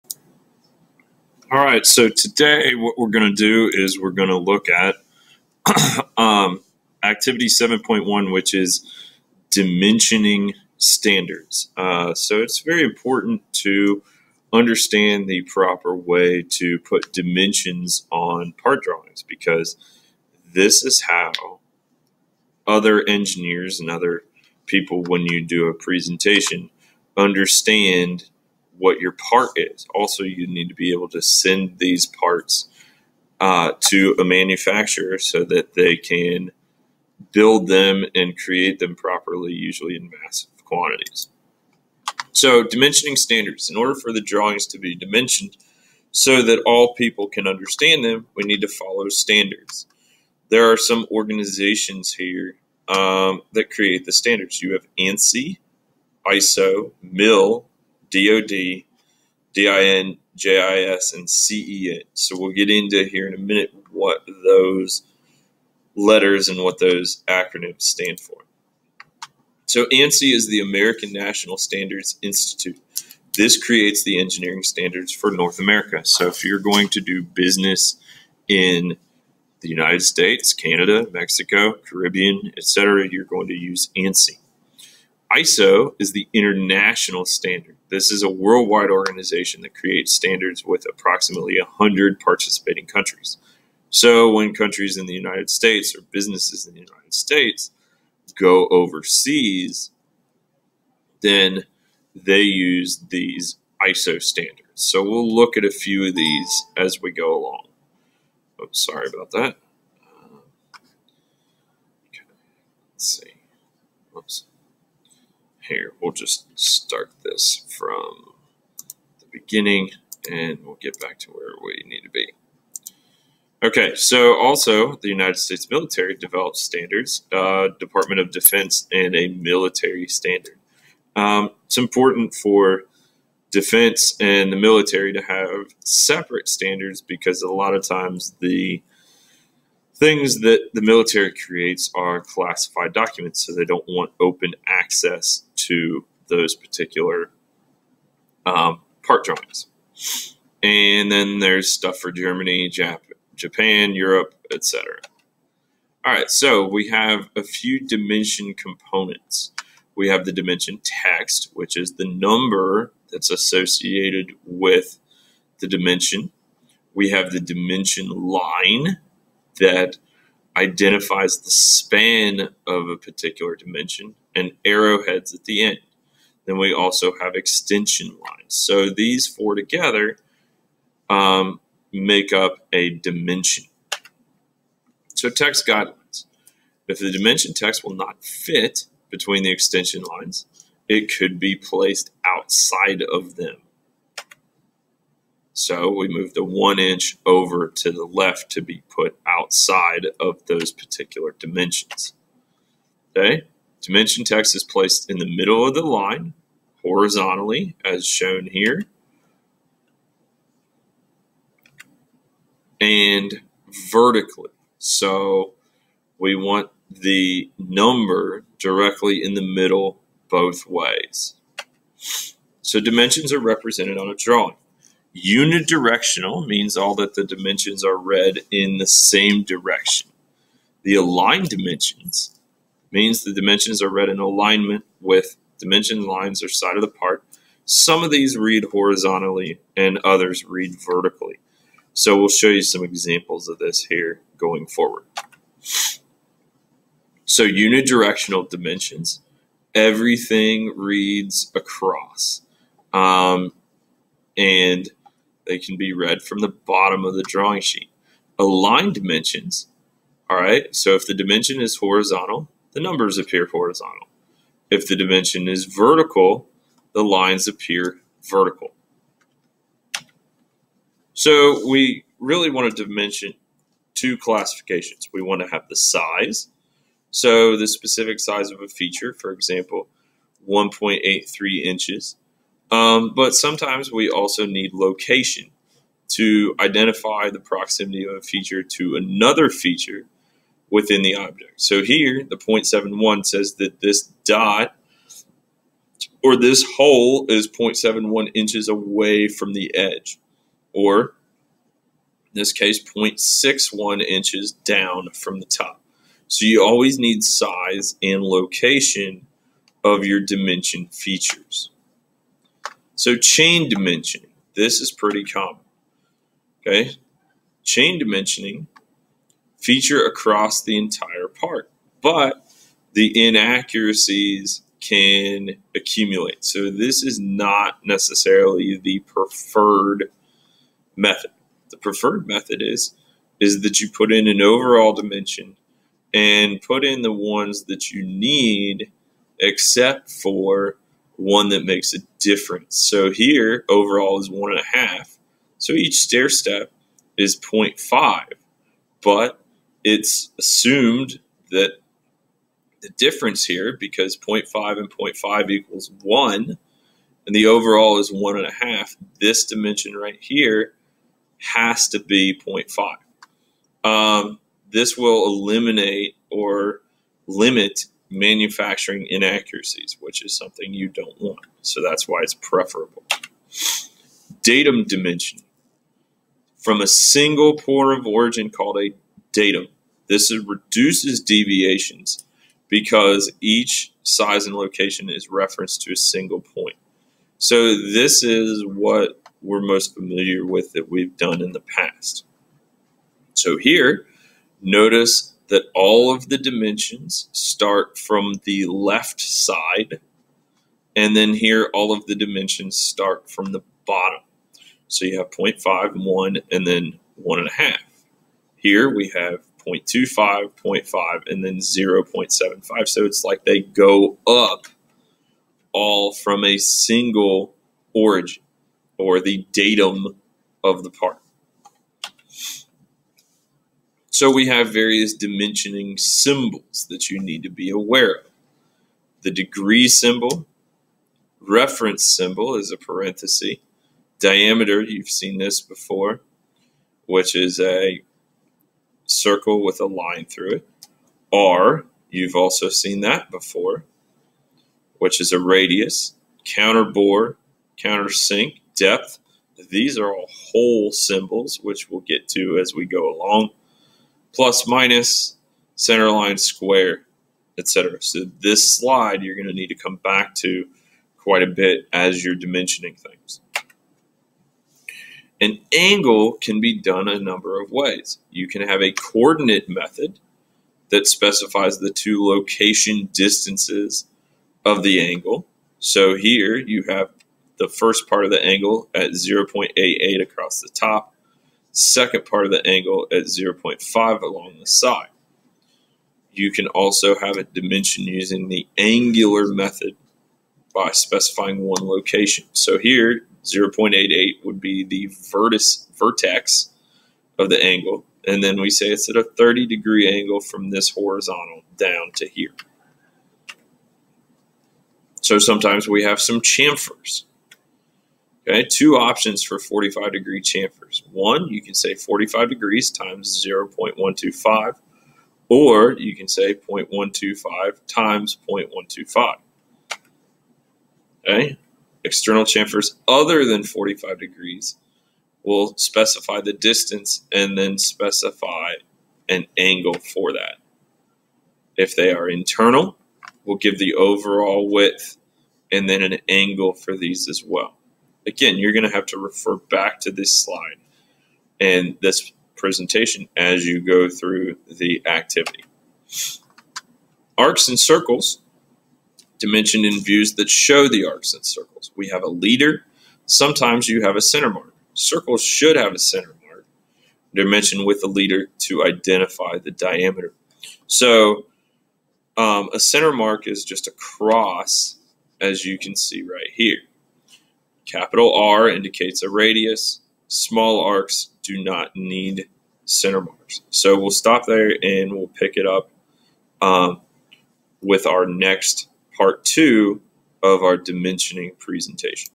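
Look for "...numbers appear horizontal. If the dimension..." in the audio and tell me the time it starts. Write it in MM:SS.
04:22.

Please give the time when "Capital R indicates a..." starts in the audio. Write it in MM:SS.
09:27.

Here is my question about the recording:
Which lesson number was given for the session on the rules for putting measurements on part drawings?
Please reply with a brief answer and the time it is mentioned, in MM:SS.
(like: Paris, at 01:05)
7.1, at 00:07.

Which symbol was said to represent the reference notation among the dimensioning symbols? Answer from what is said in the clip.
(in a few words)
parenthesis.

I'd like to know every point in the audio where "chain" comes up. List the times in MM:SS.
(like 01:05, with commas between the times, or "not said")
05:13, 05:17.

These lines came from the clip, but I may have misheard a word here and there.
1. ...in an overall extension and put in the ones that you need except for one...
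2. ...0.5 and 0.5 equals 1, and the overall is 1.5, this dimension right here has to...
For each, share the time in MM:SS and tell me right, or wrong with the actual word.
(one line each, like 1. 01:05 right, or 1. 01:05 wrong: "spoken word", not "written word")
1. 05:34 wrong: "dimension", not "extension"
2. 05:54 right.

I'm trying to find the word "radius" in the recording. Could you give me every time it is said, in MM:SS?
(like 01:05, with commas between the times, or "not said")
07:25, 09:29.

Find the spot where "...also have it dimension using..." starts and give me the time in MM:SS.
08:06.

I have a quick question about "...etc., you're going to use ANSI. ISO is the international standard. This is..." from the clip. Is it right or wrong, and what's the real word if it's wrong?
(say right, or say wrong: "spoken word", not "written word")
right.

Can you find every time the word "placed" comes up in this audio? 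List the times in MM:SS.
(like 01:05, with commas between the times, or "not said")
03:11, 03:24.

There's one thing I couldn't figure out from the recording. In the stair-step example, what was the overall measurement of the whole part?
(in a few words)
one and a half.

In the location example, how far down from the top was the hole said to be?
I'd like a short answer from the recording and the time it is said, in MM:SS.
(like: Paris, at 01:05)
0.61 inches, at 05:02.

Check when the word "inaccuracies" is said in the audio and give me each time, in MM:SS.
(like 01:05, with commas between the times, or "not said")
05:23, 06:09.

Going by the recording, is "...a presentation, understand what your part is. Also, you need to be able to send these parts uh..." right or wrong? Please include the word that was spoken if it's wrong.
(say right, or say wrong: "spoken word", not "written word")
right.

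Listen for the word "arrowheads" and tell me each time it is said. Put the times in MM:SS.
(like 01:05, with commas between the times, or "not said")
02:54.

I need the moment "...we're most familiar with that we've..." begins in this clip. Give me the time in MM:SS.
06:29.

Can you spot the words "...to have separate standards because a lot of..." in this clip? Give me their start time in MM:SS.
02:15.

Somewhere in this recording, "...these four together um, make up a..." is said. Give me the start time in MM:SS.
02:58.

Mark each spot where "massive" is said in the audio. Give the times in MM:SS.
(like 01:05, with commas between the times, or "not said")
00:40.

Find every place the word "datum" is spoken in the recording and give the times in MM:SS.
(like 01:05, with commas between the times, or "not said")
06:14, 06:19, 06:59.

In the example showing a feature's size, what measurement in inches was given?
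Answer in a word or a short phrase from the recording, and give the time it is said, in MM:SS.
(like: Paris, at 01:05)
1.83 inches, at 04:40.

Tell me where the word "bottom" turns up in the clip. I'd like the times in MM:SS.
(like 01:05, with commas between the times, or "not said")
04:16, 06:43.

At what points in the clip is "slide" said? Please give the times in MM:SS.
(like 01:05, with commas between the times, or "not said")
07:38, 09:00.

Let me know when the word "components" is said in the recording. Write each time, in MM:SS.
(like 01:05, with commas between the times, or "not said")
02:38.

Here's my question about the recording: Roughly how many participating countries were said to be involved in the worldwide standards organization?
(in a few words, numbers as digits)
100.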